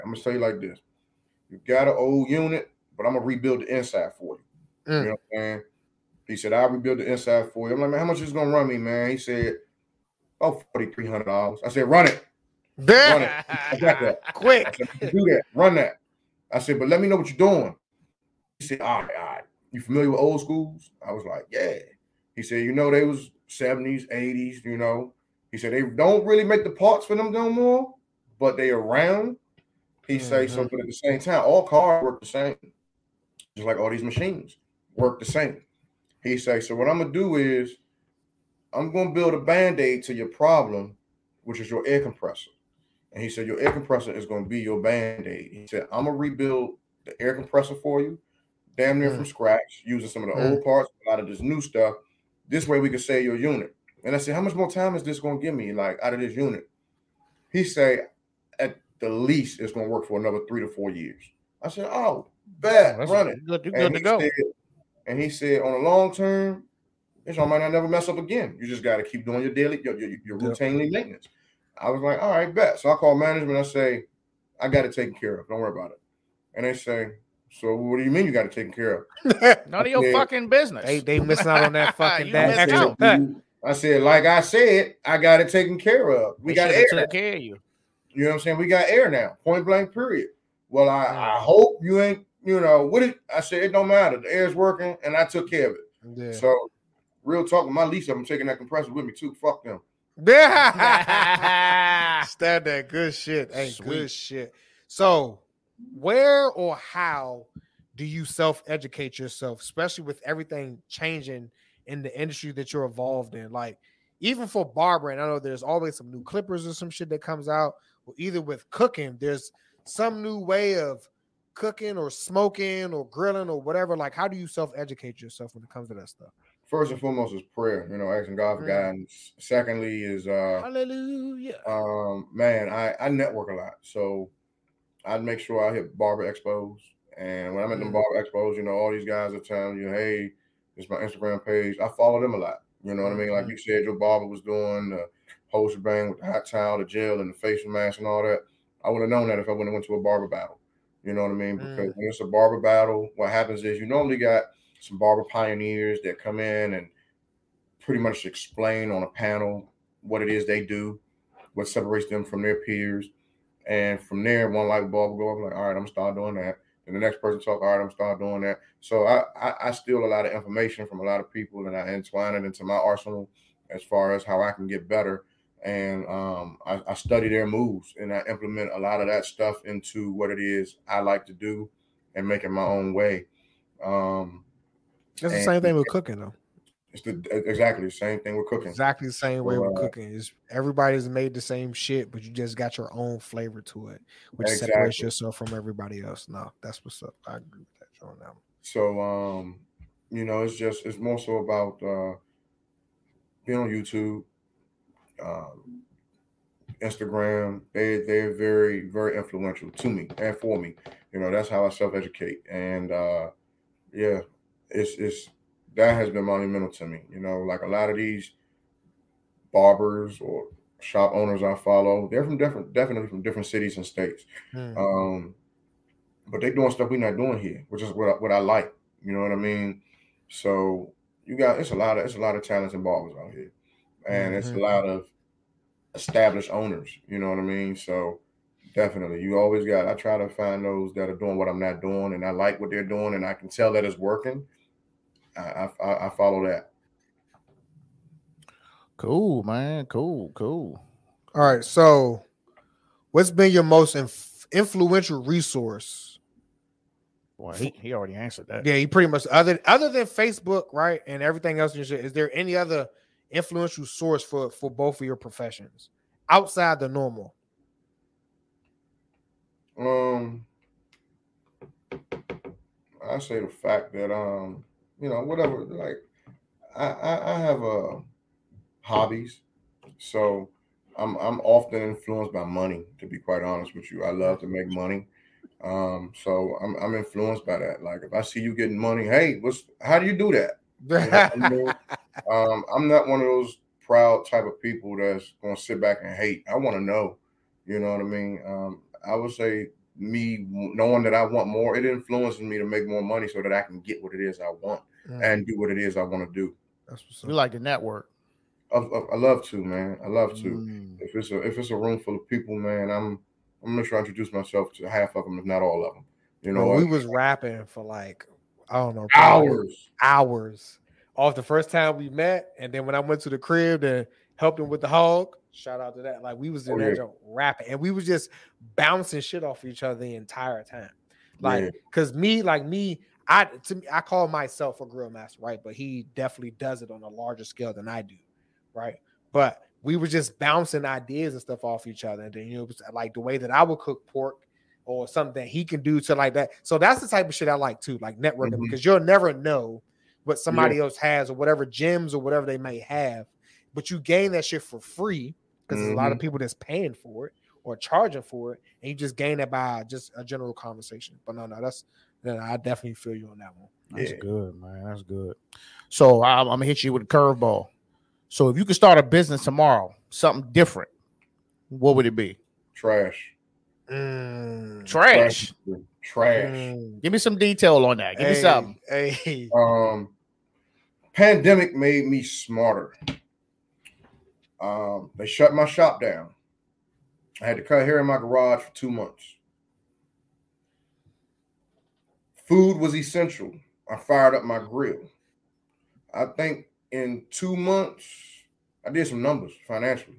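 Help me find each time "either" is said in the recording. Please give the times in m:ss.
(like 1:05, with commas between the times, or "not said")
1:58.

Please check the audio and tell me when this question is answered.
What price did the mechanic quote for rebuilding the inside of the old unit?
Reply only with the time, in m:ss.
0:10.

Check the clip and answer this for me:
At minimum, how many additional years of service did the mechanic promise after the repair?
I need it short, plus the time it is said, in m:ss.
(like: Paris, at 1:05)
three to four years, at 1:00.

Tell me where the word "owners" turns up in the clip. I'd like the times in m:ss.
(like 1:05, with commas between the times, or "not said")
3:41, 3:56.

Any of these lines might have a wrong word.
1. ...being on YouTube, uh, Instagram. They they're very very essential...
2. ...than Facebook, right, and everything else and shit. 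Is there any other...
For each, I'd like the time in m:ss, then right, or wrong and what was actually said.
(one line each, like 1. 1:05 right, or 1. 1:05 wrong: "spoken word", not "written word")
1. 3:23 wrong: "influential", not "essential"
2. 4:19 right.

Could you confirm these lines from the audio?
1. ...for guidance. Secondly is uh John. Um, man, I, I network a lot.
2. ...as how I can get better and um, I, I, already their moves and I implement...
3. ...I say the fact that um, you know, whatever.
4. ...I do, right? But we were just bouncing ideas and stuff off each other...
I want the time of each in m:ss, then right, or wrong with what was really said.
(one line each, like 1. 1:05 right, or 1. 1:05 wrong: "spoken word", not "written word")
1. 2:08 wrong: "Hallelujah", not "John"
2. 2:54 wrong: "study", not "already"
3. 4:33 right
4. 5:37 right.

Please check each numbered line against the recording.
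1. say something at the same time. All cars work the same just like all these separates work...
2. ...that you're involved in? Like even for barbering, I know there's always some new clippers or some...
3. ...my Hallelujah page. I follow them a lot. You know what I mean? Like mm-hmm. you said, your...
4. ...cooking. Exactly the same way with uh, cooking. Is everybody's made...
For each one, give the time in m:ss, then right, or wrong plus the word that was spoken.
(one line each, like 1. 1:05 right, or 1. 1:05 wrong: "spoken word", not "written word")
1. 0:30 wrong: "machines", not "separates"
2. 1:52 right
3. 2:20 wrong: "Instagram", not "Hallelujah"
4. 3:08 right.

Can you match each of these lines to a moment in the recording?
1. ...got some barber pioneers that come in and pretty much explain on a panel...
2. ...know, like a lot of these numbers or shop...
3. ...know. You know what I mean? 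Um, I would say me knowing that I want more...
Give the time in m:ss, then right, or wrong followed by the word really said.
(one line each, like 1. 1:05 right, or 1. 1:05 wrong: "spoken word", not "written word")
1. 2:34 right
2. 3:37 wrong: "barbers", not "numbers"
3. 4:56 right.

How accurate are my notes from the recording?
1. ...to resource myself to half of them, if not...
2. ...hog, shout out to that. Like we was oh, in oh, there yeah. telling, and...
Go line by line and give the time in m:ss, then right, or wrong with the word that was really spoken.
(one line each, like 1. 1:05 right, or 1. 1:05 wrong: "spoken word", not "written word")
1. 5:14 wrong: "introduce", not "resource"
2. 5:24 wrong: "rapping", not "telling".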